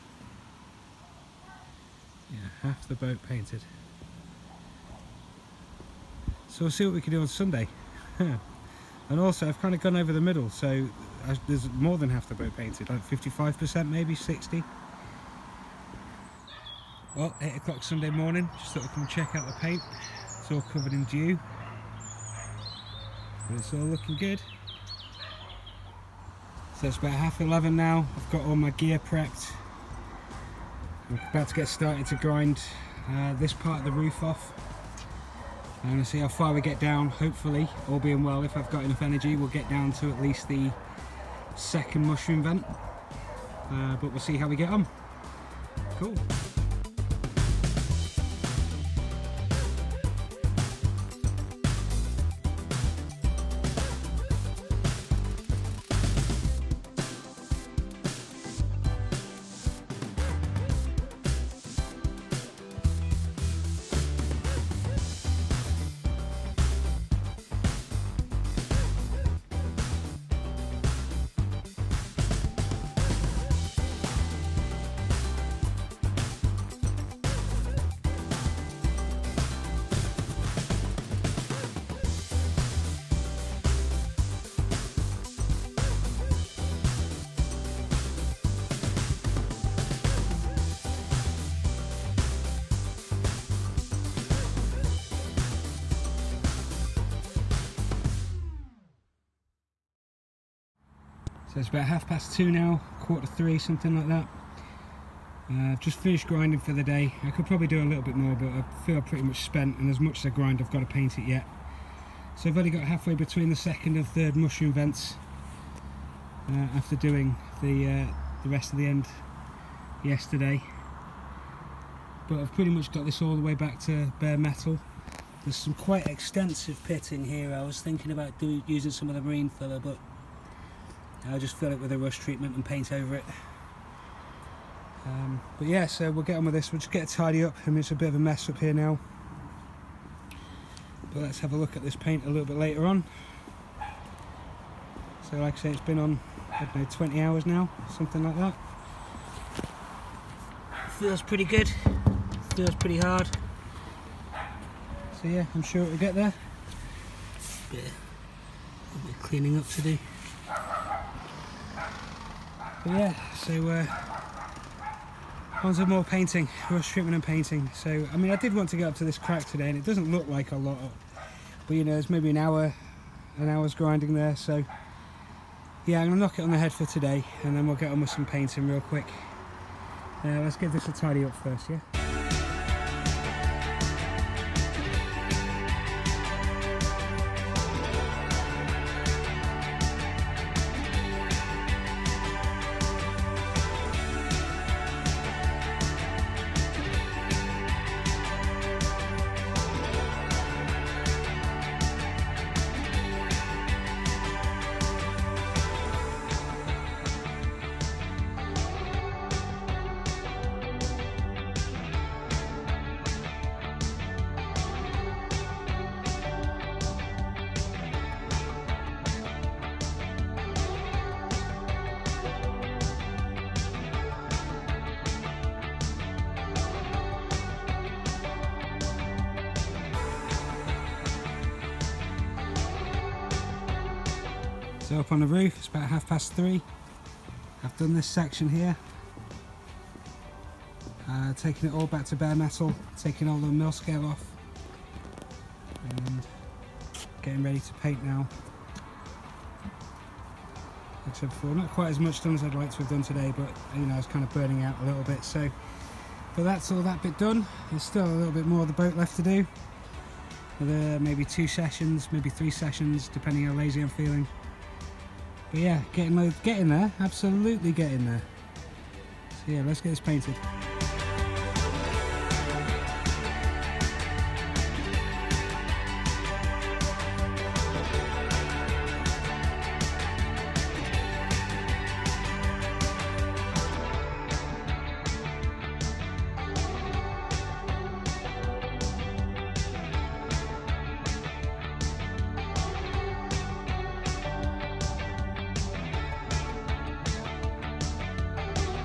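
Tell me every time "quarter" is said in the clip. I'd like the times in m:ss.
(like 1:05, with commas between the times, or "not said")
1:42.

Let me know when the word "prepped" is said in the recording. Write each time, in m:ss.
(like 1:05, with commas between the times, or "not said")
0:28.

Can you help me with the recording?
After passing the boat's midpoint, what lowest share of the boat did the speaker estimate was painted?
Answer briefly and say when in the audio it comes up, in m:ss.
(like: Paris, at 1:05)
55%, at 0:13.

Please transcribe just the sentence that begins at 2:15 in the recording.
Um, but yeah, so we'll get on with this.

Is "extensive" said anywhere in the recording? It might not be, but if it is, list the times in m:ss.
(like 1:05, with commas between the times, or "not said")
2:06.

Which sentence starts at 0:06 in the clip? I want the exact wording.
So we'll see what we can do on Sunday.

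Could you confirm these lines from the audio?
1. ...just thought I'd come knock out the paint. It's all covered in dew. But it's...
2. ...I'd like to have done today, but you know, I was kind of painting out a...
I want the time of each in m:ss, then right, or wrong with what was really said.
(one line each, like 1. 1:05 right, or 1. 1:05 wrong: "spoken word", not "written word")
1. 0:18 wrong: "check", not "knock"
2. 4:12 wrong: "burning", not "painting".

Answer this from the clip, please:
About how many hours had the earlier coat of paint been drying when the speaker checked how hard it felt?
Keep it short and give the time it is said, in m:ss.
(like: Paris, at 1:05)
20 hours, at 2:26.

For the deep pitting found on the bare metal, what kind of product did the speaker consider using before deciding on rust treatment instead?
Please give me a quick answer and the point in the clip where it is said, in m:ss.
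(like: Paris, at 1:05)
marine filler, at 2:09.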